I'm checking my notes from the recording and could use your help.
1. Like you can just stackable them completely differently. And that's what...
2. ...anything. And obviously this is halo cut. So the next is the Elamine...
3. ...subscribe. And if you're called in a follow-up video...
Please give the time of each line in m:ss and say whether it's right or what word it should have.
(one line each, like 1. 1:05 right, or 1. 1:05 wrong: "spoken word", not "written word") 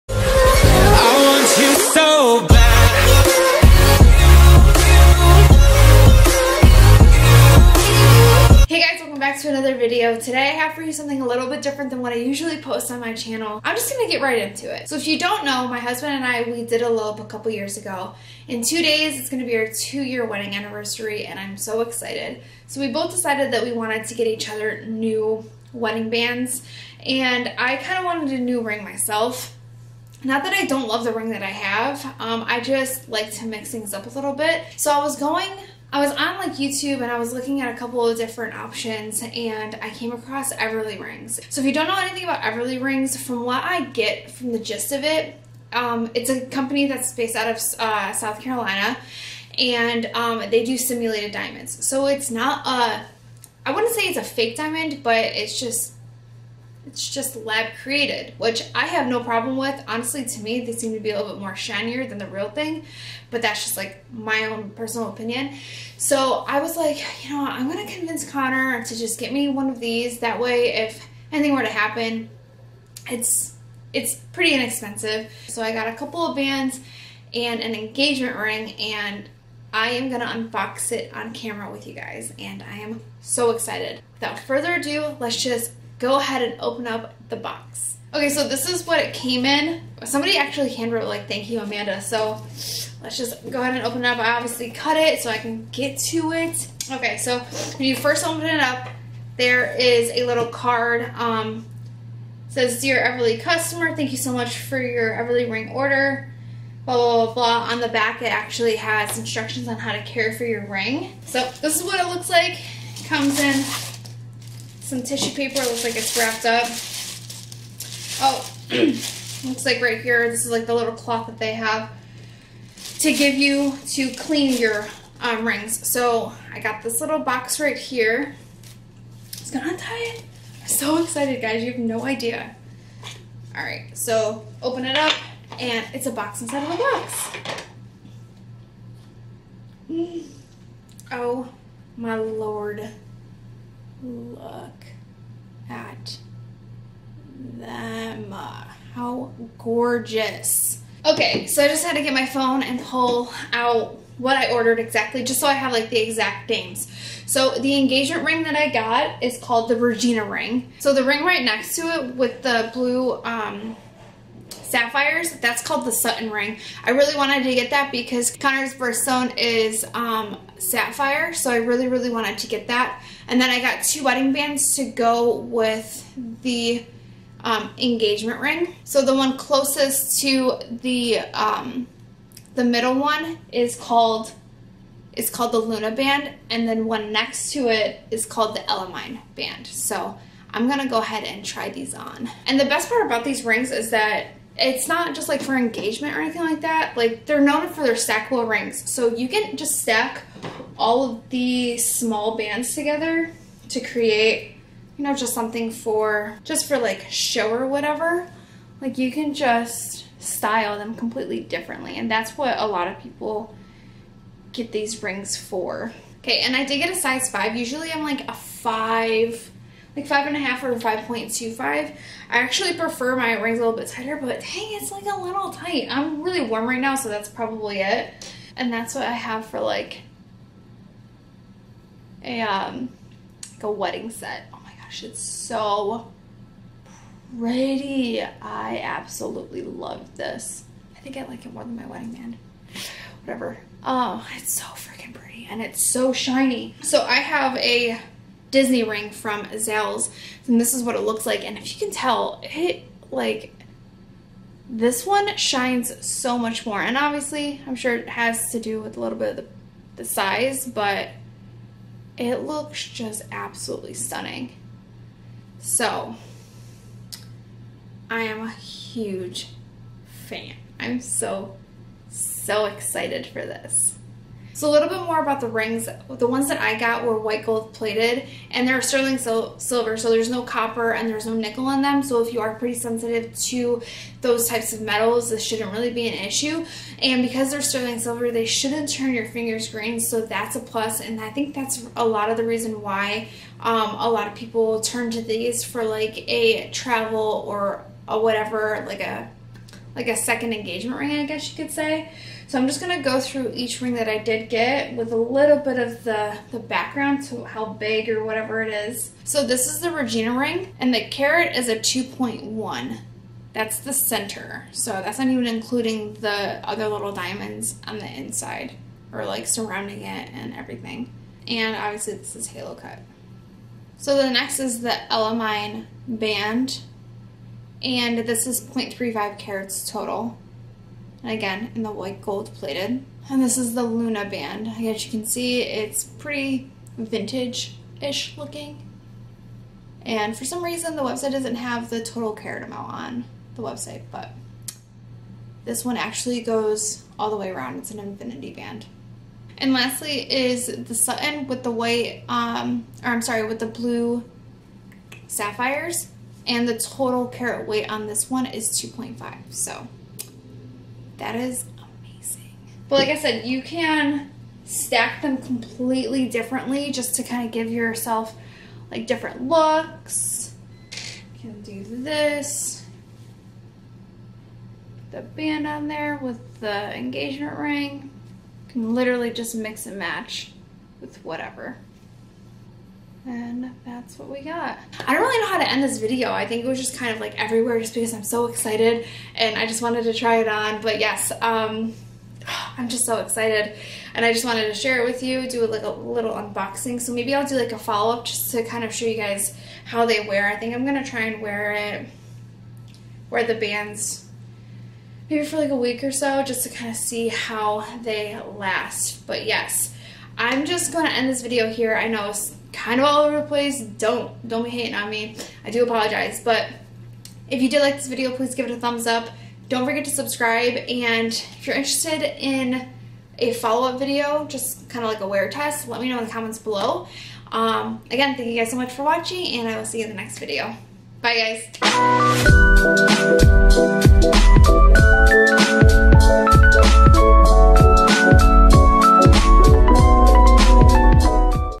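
1. 3:28 wrong: "style", not "stackable"
2. 5:20 wrong: "everything", not "anything"
3. 7:00 wrong: "interested", not "called".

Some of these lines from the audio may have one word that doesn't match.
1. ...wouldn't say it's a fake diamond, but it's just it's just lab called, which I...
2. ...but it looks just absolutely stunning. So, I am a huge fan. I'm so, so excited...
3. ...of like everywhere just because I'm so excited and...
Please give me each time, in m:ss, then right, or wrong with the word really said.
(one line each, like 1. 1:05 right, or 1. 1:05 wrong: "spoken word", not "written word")
1. 0:53 wrong: "created", not "called"
2. 4:20 right
3. 6:27 right.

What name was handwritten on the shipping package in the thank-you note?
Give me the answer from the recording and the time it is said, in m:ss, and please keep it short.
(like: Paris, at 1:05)
Amanda, at 1:31.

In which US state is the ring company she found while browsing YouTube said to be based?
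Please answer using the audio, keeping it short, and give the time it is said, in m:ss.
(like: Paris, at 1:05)
South Carolina, at 0:48.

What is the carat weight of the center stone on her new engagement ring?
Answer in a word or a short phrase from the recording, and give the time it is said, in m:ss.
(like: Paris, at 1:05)
2.1, at 5:11.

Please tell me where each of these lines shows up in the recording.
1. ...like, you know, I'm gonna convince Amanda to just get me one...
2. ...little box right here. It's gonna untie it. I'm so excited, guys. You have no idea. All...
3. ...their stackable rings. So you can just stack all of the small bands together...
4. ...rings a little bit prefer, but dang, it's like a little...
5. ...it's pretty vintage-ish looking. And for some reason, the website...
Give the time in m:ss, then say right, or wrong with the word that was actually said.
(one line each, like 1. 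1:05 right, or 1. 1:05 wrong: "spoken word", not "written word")
1. 1:06 wrong: "Connor", not "Amanda"
2. 2:06 right
3. 3:17 right
4. 3:43 wrong: "tighter", not "prefer"
5. 5:35 right.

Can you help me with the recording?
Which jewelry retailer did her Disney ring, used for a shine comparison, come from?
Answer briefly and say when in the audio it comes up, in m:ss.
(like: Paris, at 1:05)
Zales, at 4:09.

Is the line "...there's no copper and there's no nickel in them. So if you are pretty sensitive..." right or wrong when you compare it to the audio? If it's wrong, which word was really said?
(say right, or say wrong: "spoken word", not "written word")
right.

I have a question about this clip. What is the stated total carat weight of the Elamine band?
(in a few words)
0.35 carats.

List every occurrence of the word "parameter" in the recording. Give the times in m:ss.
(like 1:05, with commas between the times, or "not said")
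not said.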